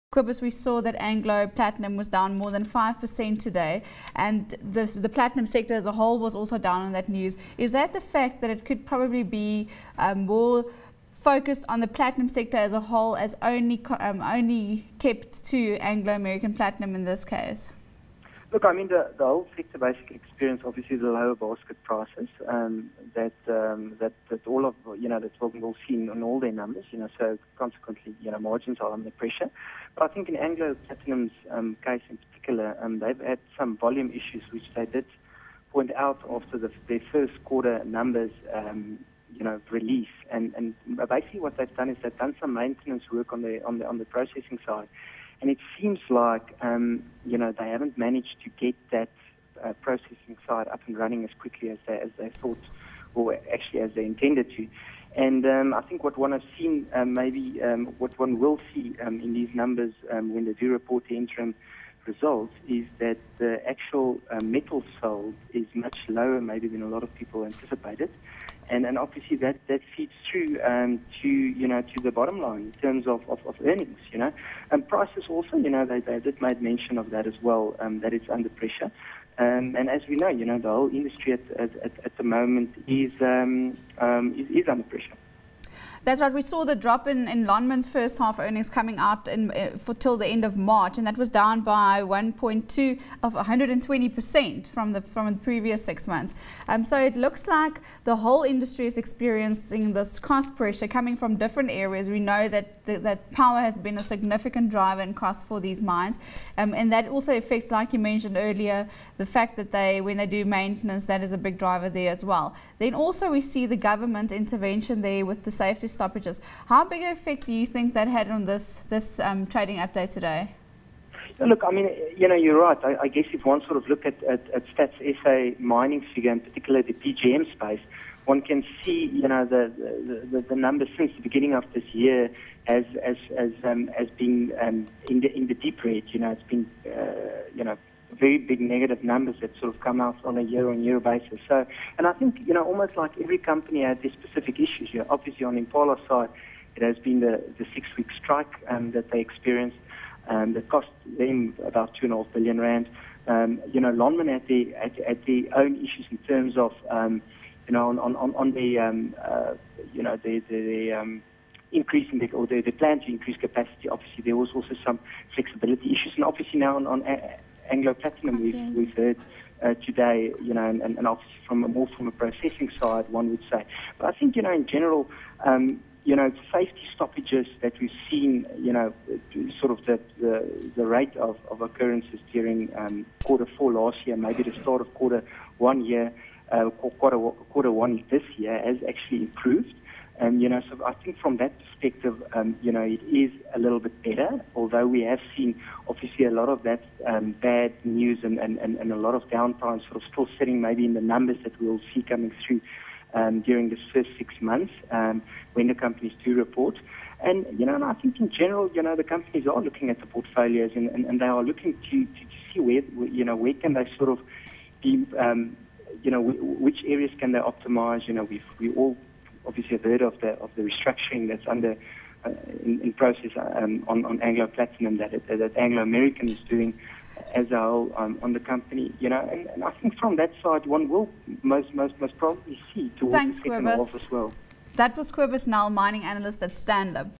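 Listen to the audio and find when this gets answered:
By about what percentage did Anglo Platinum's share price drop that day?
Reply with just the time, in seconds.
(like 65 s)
2 s.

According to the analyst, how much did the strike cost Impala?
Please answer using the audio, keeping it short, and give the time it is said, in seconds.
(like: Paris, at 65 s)
2.5 billion rand, at 151 s.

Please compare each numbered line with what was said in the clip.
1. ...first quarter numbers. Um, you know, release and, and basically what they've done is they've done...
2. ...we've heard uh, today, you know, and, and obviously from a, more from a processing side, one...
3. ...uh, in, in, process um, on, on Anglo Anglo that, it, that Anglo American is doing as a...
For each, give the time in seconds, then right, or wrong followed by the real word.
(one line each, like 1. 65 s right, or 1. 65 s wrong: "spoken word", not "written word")
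1. 37 s right
2. 168 s right
3. 222 s wrong: "Platinum", not "Anglo".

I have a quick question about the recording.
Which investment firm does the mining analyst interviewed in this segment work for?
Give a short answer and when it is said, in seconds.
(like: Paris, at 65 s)
Stanlib, at 236 s.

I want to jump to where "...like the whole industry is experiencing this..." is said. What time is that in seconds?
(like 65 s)
97 s.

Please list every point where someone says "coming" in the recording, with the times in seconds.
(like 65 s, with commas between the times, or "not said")
88 s, 100 s, 202 s.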